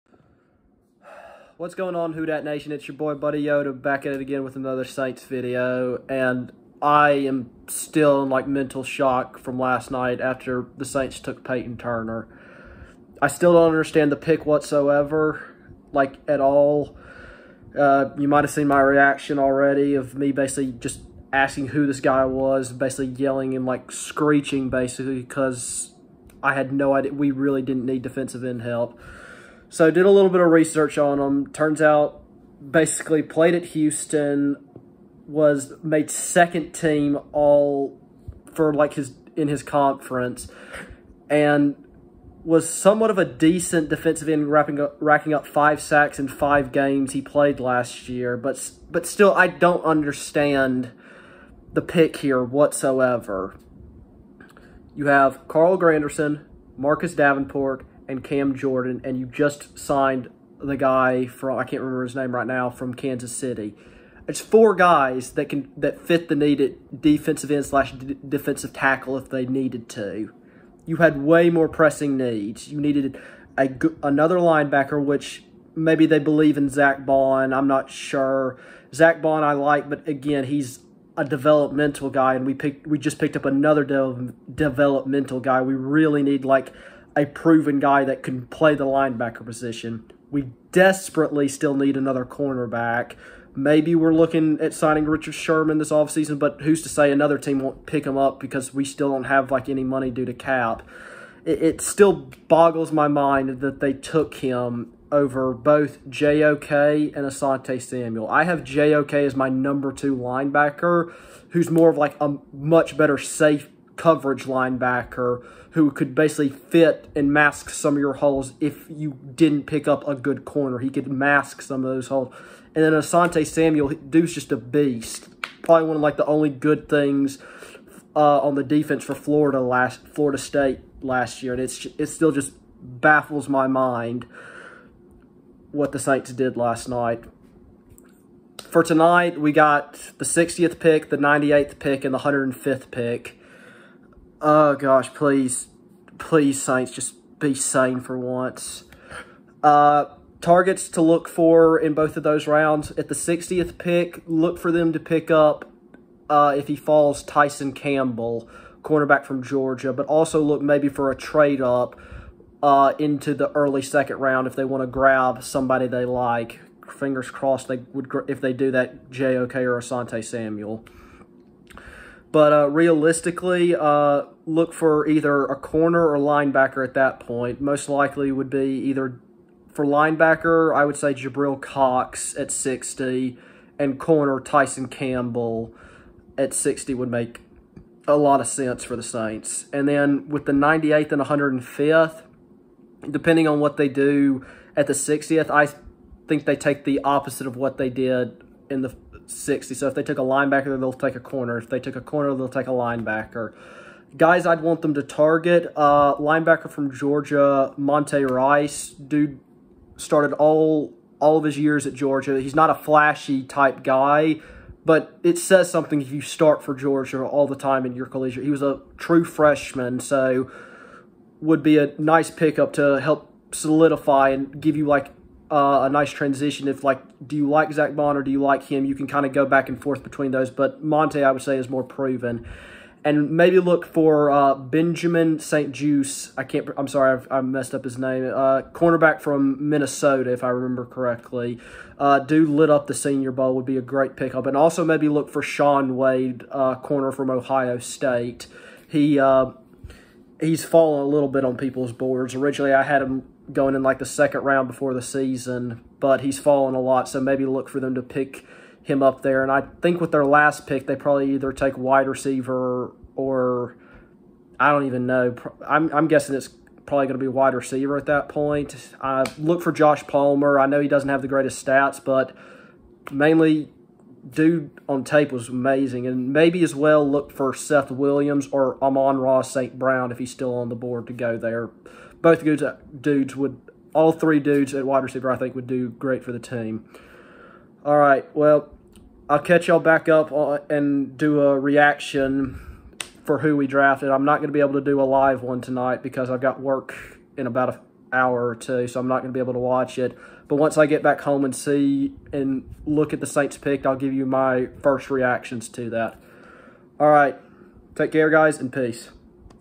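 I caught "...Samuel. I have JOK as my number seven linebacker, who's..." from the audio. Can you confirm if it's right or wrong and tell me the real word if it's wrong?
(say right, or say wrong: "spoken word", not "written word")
wrong: "two", not "seven".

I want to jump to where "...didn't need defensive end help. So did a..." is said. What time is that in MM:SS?
00:27.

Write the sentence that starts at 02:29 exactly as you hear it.
Uh, targets to look for in both of those rounds.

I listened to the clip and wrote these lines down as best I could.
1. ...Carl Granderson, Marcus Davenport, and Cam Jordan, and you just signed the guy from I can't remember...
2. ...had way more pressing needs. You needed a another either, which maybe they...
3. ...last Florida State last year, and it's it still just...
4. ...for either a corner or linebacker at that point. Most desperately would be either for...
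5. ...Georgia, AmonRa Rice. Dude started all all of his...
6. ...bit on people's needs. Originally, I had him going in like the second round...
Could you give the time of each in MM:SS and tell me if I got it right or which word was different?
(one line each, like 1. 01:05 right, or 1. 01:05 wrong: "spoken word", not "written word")
1. 00:55 right
2. 01:10 wrong: "linebacker", not "either"
3. 02:09 right
4. 02:54 wrong: "likely", not "desperately"
5. 03:26 wrong: "Monty", not "AmonRa"
6. 04:11 wrong: "boards", not "needs".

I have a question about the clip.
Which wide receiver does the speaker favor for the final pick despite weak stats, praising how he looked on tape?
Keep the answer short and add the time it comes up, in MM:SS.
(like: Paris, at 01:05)
Josh Palmer, at 04:29.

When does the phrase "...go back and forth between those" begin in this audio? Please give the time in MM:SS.
03:49.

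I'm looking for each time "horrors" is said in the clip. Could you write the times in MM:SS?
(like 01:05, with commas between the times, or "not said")
not said.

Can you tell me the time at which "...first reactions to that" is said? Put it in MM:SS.
05:04.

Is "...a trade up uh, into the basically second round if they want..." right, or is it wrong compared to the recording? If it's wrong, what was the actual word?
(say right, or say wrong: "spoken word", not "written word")
wrong: "early", not "basically".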